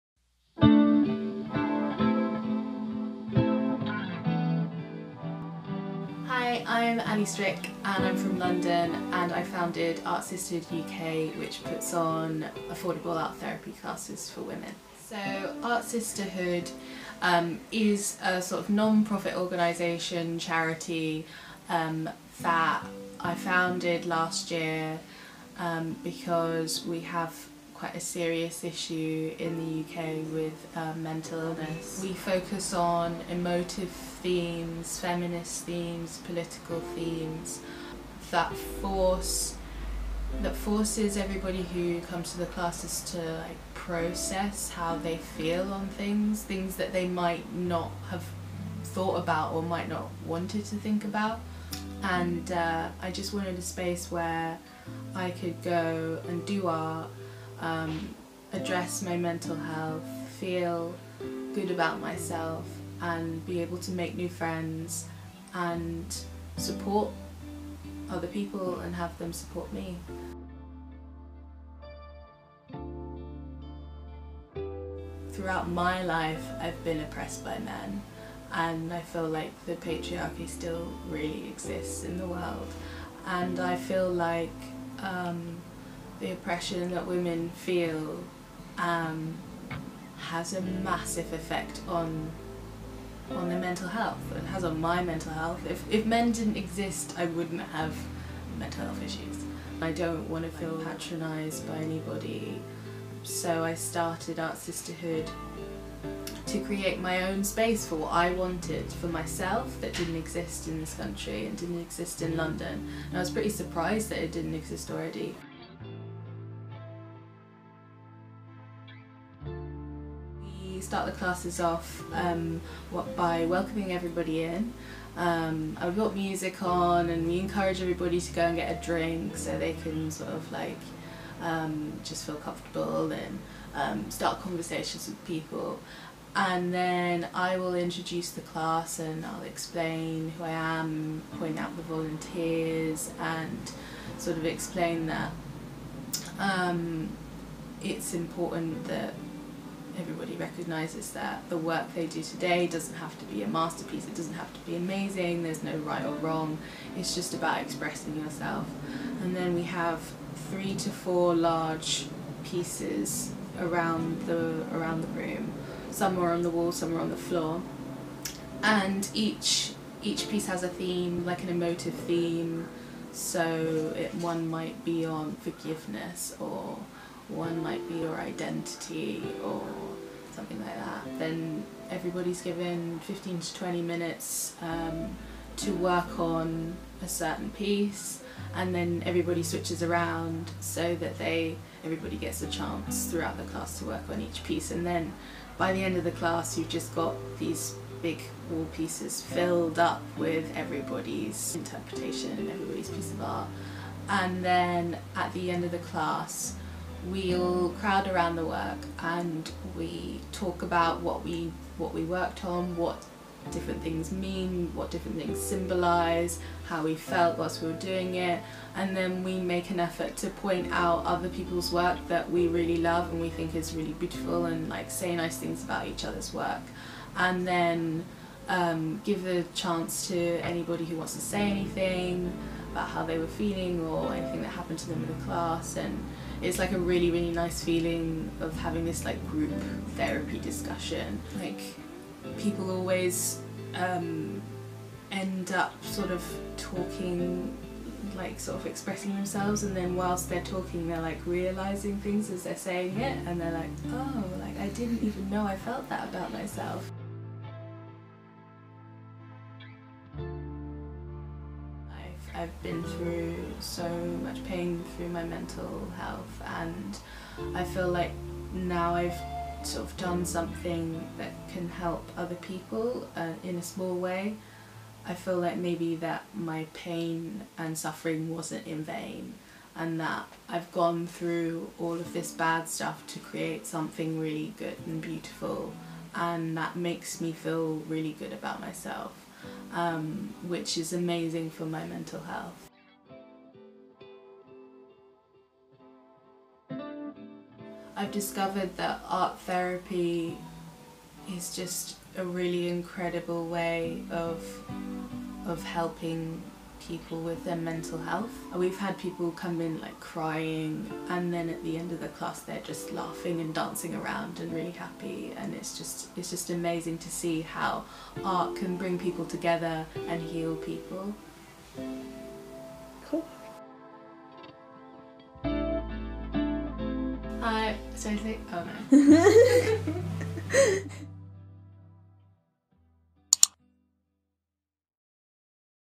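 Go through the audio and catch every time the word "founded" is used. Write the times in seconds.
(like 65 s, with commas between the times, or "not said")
9 s, 23 s.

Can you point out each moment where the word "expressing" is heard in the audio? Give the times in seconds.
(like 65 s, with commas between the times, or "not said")
157 s, 248 s.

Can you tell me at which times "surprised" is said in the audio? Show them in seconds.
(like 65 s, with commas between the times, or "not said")
113 s.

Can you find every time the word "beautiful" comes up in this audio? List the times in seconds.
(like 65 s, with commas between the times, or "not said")
223 s, 284 s.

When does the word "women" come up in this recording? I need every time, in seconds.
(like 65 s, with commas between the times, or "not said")
14 s, 87 s.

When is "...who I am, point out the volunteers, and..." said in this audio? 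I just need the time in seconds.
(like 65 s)
140 s.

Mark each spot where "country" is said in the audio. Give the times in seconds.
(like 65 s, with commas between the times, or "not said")
110 s.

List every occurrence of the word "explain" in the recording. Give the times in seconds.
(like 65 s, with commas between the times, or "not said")
139 s, 144 s.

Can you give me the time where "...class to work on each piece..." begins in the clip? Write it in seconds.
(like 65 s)
193 s.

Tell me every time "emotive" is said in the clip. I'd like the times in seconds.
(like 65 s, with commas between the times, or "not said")
33 s, 171 s.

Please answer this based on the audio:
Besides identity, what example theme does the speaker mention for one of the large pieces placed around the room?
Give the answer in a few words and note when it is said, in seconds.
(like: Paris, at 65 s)
forgiveness, at 175 s.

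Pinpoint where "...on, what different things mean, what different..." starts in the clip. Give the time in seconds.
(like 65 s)
212 s.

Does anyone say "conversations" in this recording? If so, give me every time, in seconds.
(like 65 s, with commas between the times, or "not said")
134 s.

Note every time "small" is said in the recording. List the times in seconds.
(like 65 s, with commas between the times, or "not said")
273 s.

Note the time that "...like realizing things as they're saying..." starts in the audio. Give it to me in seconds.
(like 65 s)
251 s.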